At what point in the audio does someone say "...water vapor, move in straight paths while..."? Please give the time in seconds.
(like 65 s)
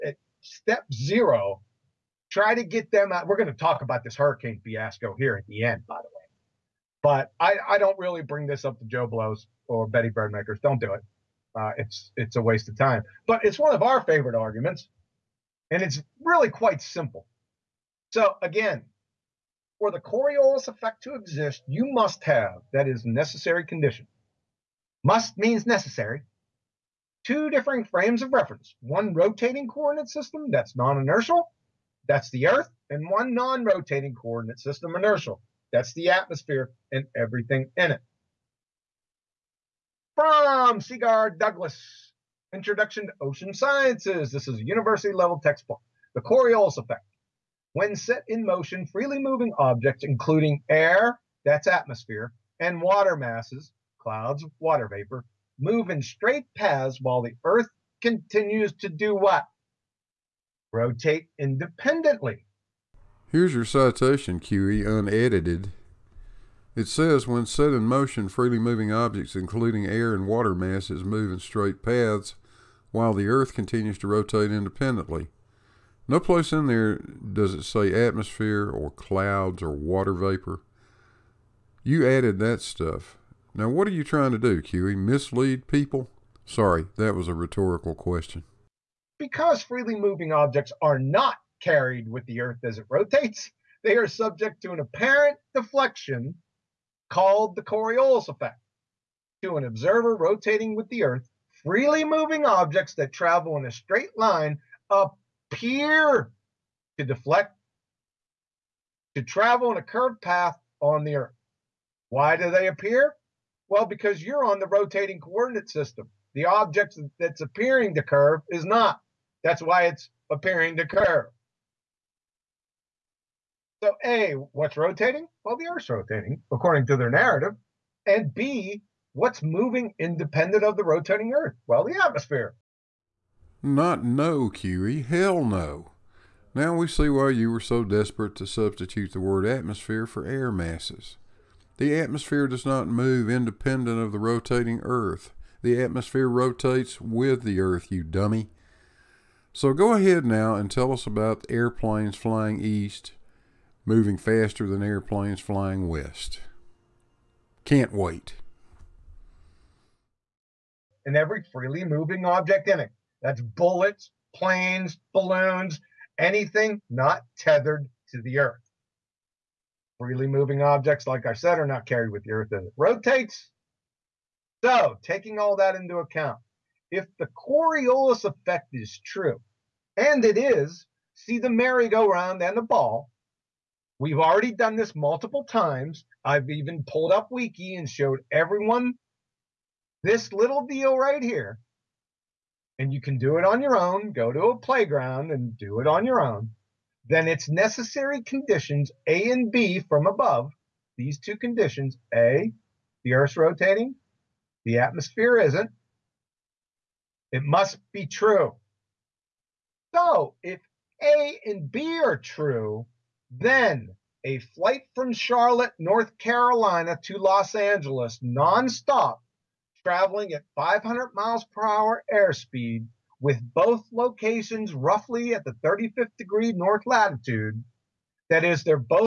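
54 s.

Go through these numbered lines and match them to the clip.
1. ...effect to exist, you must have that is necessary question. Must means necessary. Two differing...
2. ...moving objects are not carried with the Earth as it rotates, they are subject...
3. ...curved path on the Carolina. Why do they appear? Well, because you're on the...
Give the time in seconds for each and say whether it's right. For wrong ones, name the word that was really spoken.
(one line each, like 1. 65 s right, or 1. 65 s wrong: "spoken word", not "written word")
1. 20 s wrong: "condition", not "question"
2. 89 s right
3. 109 s wrong: "Earth", not "Carolina".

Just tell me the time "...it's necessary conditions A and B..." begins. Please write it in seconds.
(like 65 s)
197 s.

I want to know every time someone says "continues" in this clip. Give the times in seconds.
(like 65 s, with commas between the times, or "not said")
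57 s, 73 s.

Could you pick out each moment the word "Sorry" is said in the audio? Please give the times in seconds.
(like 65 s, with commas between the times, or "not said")
86 s.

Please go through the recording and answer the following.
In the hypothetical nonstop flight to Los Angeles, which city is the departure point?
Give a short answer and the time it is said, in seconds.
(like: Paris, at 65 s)
Charlotte, North Carolina, at 215 s.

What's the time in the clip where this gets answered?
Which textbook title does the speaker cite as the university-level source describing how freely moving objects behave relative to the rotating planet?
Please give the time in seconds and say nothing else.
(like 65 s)
42 s.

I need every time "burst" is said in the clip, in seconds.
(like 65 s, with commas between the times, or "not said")
not said.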